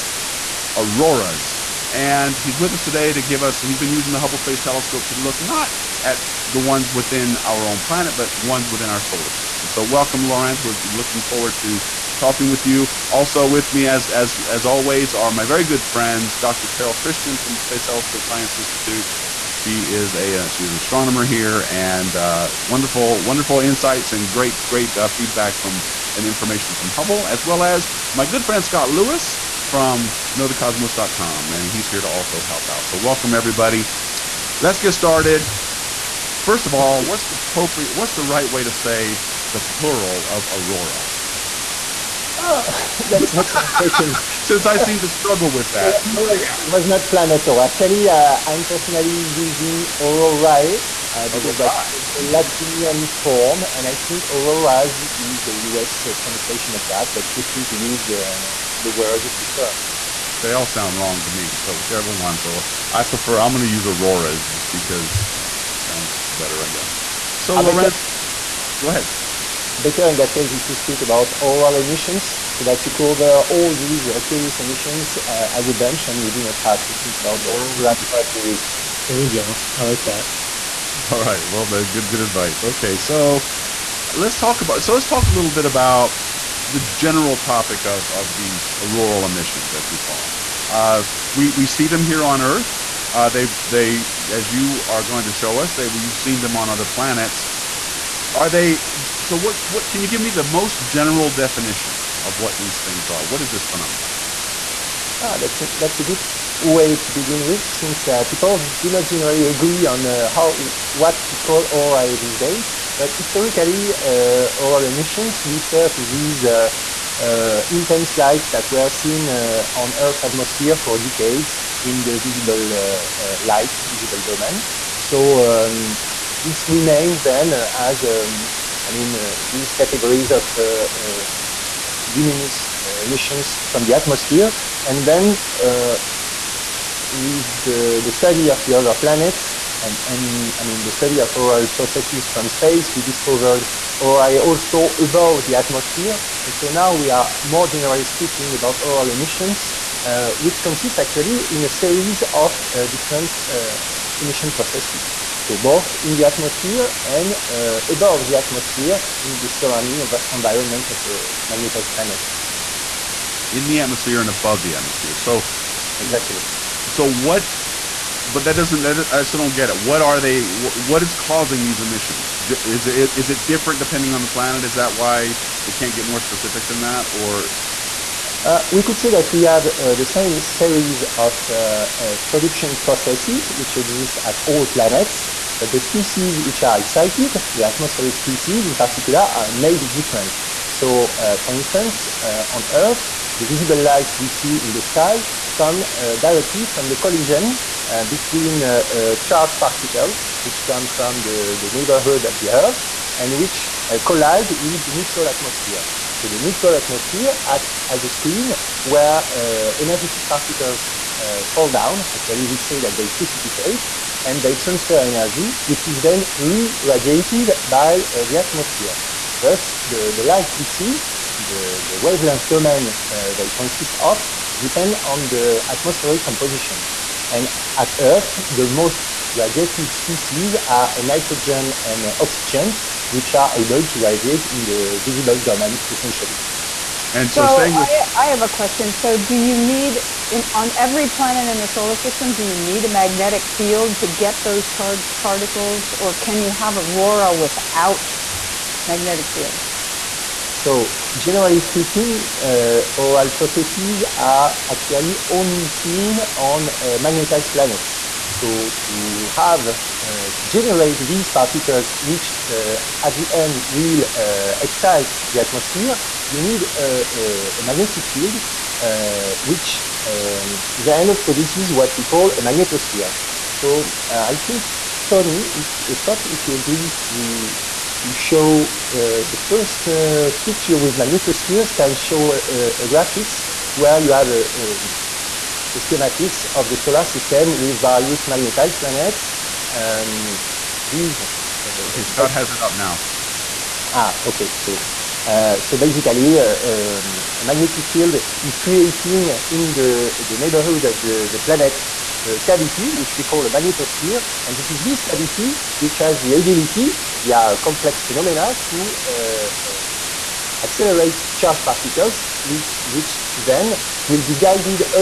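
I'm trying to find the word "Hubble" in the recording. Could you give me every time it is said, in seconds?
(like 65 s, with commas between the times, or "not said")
4 s, 26 s.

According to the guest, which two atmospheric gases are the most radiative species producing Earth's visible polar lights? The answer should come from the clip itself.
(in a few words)
nitrogen and oxygen.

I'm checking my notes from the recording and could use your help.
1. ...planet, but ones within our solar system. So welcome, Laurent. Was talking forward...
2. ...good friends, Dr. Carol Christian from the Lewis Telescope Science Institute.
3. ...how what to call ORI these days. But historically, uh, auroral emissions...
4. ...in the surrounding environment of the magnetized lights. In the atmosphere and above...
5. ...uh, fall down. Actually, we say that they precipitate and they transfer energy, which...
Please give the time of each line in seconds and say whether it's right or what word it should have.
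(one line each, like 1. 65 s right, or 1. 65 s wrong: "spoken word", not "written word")
1. 7 s wrong: "looking", not "talking"
2. 15 s wrong: "Space", not "Lewis"
3. 110 s right
4. 159 s wrong: "planets", not "lights"
5. 211 s right.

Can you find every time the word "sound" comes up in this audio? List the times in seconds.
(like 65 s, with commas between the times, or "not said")
60 s, 65 s.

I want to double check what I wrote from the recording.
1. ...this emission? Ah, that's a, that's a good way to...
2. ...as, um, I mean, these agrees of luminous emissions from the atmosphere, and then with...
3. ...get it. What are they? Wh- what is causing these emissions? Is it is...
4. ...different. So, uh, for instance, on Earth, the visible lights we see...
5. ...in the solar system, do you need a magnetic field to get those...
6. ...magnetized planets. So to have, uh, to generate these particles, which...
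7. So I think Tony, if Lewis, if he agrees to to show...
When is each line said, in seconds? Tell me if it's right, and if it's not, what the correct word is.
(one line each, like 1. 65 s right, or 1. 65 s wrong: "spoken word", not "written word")
1. 103 s wrong: "phenomenon", not "emission"
2. 127 s wrong: "categories", not "agrees"
3. 169 s right
4. 189 s right
5. 241 s right
6. 257 s right
7. 273 s wrong: "Scott", not "Lewis".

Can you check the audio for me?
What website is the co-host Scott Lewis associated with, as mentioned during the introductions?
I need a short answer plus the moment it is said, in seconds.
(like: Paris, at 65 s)
knowthecosmos.com, at 30 s.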